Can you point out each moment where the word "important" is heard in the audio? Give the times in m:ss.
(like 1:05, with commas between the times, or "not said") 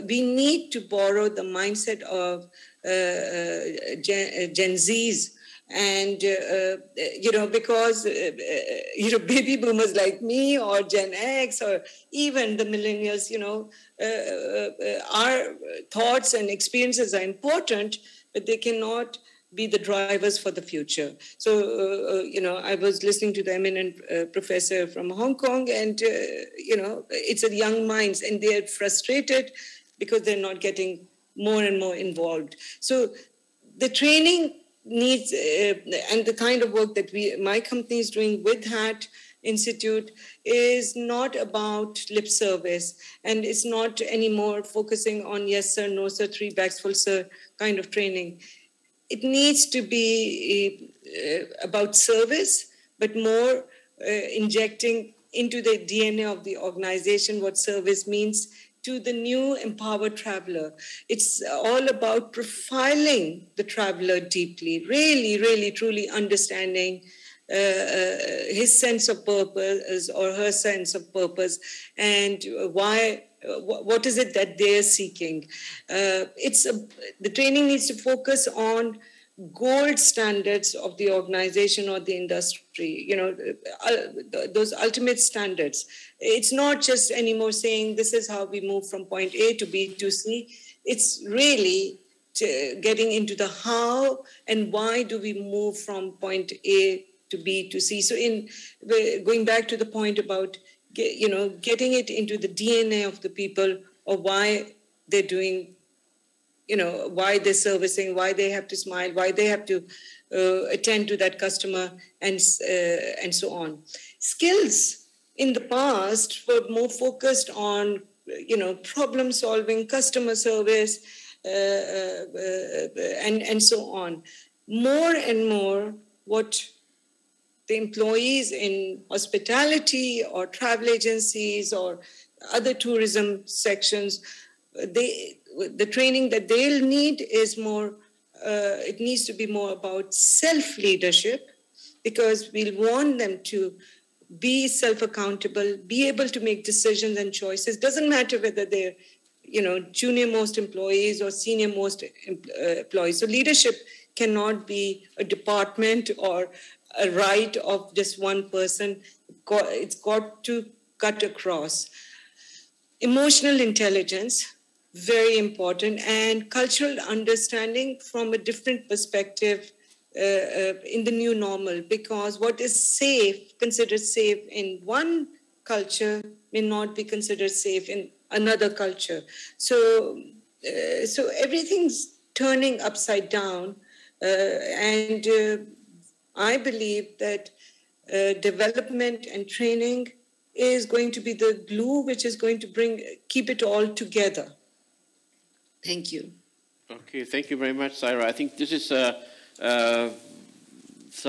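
0:17, 2:45.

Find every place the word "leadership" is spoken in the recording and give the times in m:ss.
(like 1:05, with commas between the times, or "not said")
2:20, 2:33.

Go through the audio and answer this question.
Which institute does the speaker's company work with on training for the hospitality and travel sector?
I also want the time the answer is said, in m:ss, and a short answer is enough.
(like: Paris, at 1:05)
HATT Institute, at 0:38.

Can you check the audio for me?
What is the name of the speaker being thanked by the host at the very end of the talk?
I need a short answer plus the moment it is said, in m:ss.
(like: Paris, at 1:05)
Saira, at 3:17.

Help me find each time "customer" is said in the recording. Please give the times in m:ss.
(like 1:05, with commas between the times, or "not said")
1:51, 1:59.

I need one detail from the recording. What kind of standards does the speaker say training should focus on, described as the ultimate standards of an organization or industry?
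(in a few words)
Gold standards.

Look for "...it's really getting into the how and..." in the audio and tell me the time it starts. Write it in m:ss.
1:30.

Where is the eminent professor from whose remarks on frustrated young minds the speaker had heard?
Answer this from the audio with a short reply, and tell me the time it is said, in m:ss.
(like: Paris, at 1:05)
Hong Kong, at 0:25.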